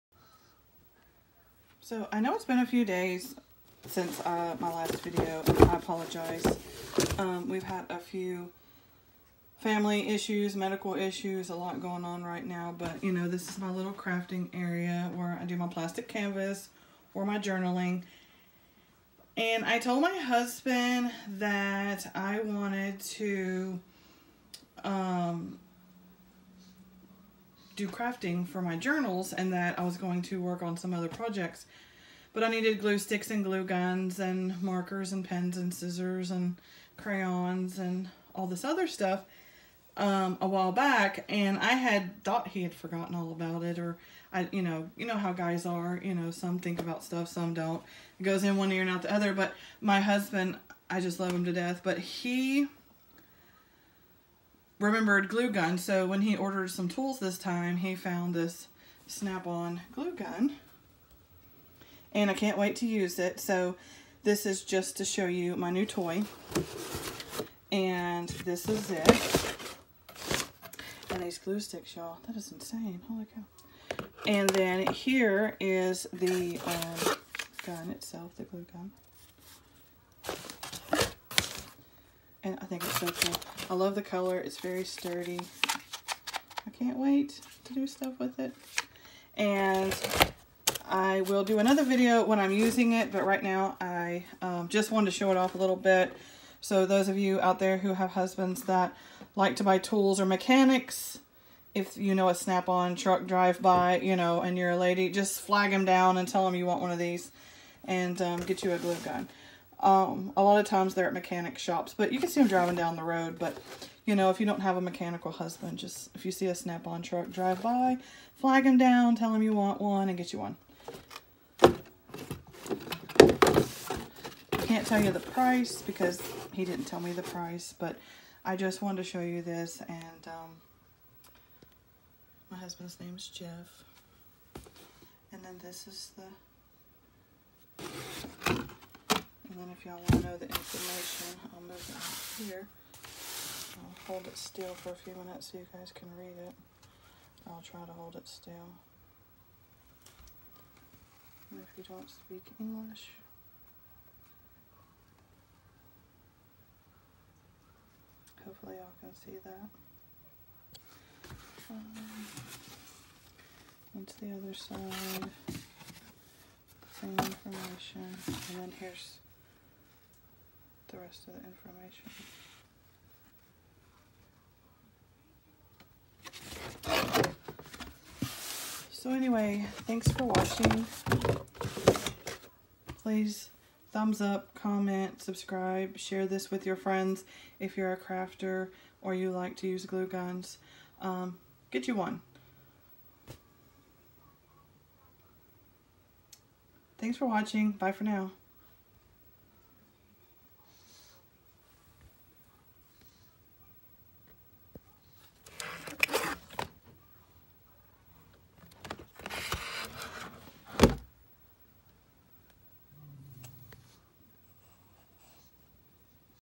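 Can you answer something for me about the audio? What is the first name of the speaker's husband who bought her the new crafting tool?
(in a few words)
Jeff.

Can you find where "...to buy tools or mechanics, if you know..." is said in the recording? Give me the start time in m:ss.
1:39.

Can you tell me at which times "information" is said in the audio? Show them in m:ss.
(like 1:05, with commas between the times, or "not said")
2:20, 2:47, 2:56.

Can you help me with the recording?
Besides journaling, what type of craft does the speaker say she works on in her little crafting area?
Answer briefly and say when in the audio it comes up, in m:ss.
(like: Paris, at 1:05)
plastic canvas, at 0:15.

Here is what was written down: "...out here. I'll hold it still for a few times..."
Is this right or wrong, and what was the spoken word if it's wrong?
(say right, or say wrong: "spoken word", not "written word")
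wrong: "minutes", not "times".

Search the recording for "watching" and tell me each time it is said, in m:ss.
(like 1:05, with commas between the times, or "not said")
3:00, 3:17.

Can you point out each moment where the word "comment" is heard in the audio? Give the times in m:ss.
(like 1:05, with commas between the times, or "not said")
3:04.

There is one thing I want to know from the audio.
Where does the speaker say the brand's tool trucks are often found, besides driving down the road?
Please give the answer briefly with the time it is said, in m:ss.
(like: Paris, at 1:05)
mechanic shops, at 1:51.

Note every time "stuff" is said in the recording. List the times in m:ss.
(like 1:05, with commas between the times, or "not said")
0:38, 0:47, 1:27.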